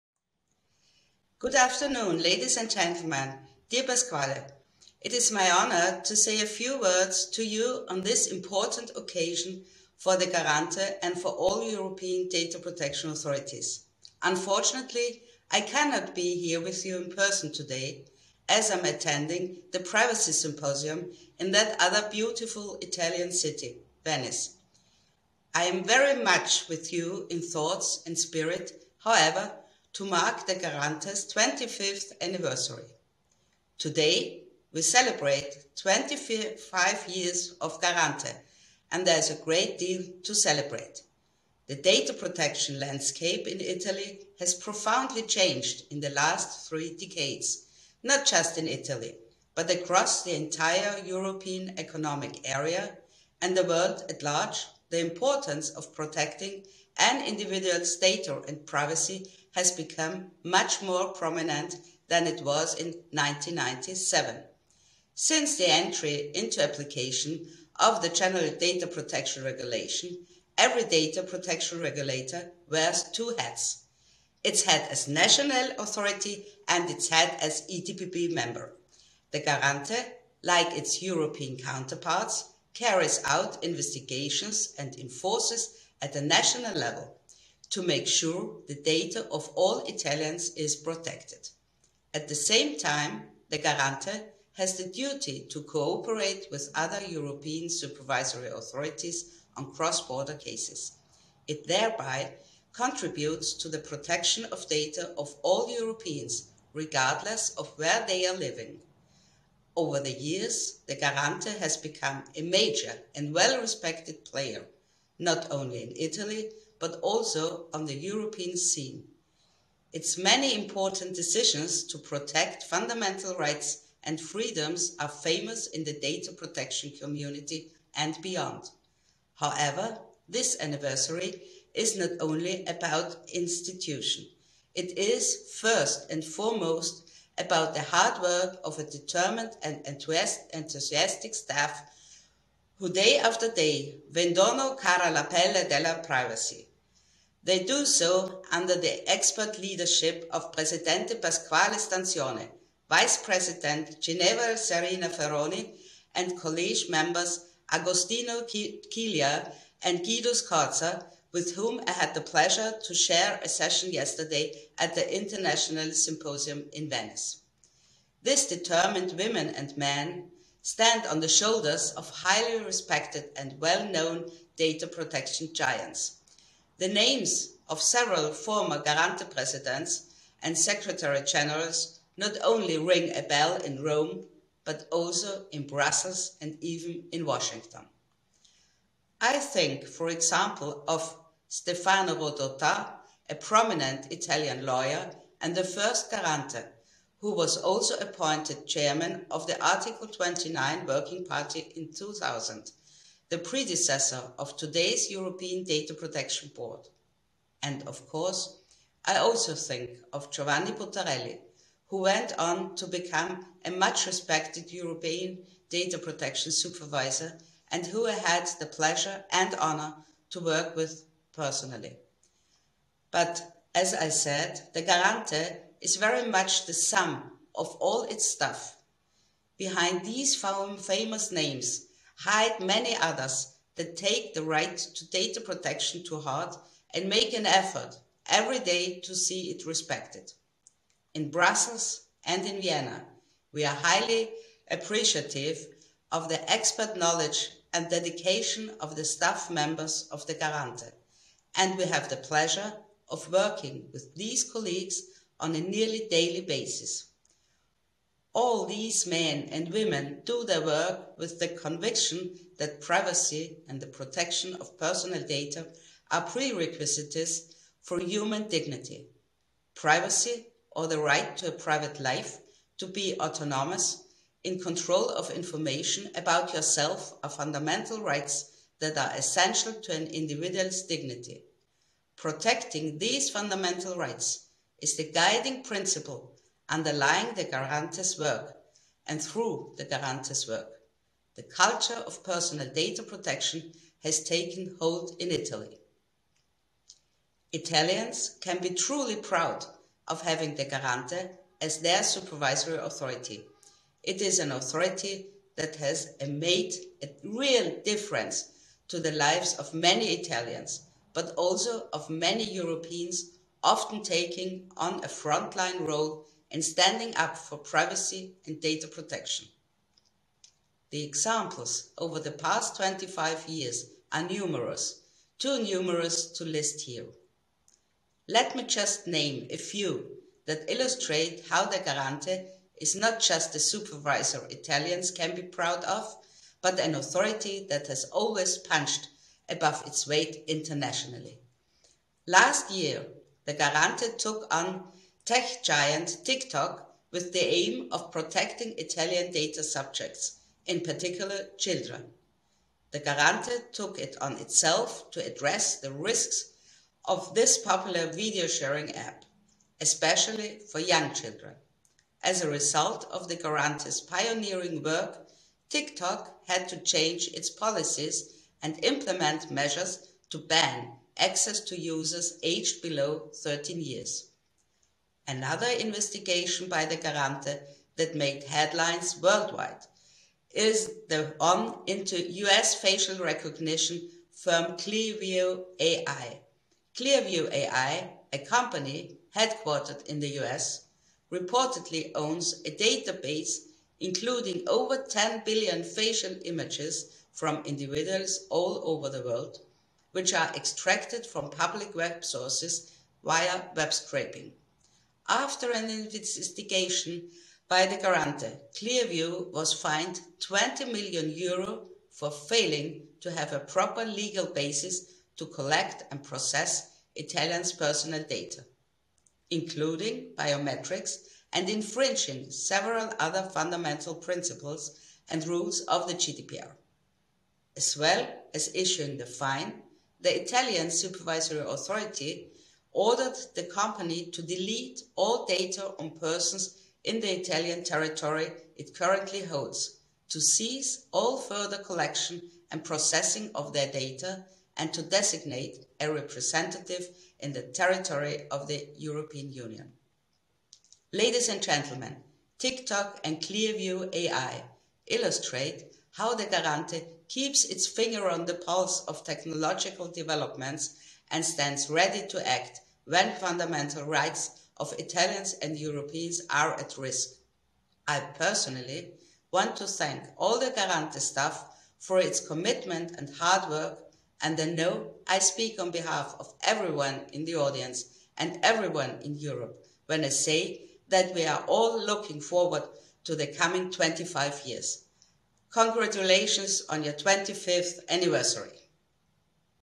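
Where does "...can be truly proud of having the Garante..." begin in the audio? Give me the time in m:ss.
4:58.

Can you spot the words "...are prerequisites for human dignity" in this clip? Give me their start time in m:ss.
4:26.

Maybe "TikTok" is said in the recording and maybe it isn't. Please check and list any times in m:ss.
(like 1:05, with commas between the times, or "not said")
5:46, 6:05, 7:32.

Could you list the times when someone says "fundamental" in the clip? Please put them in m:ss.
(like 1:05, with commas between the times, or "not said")
2:02, 4:37, 4:43, 7:03, 7:43.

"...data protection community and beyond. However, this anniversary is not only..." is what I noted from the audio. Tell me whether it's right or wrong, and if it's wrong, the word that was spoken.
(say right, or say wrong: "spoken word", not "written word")
right.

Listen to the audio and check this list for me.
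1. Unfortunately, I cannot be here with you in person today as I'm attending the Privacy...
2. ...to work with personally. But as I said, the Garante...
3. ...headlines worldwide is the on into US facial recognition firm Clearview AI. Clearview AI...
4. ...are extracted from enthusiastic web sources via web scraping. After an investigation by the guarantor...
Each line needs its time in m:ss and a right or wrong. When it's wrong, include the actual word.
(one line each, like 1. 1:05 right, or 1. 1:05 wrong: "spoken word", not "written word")
1. 0:14 right
2. 3:40 right
3. 6:18 right
4. 6:40 wrong: "public", not "enthusiastic".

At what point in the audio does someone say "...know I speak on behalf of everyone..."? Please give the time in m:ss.
7:54.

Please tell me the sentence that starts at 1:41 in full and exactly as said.
It thereby contributes to the protection of data of all Europeans, regardless of where they are living.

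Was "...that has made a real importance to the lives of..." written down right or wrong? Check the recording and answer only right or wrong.
wrong.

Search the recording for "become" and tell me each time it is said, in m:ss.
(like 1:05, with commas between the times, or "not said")
0:59, 1:51, 3:32.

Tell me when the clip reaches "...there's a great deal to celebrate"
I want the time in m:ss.
0:39.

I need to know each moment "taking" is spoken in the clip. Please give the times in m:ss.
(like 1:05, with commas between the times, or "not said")
5:14.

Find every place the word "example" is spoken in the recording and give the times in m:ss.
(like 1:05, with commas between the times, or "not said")
3:10, 5:21.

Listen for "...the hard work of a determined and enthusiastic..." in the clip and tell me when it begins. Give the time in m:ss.
2:17.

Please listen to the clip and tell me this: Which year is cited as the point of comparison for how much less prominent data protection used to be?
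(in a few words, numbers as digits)
1997.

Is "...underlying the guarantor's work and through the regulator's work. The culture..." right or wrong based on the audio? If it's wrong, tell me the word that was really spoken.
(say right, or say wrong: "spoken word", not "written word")
wrong: "guarantor", not "regulator".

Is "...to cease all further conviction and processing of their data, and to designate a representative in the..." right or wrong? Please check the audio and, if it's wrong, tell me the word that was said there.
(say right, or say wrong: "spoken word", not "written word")
wrong: "collection", not "conviction".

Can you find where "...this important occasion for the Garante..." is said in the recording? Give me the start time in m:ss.
0:08.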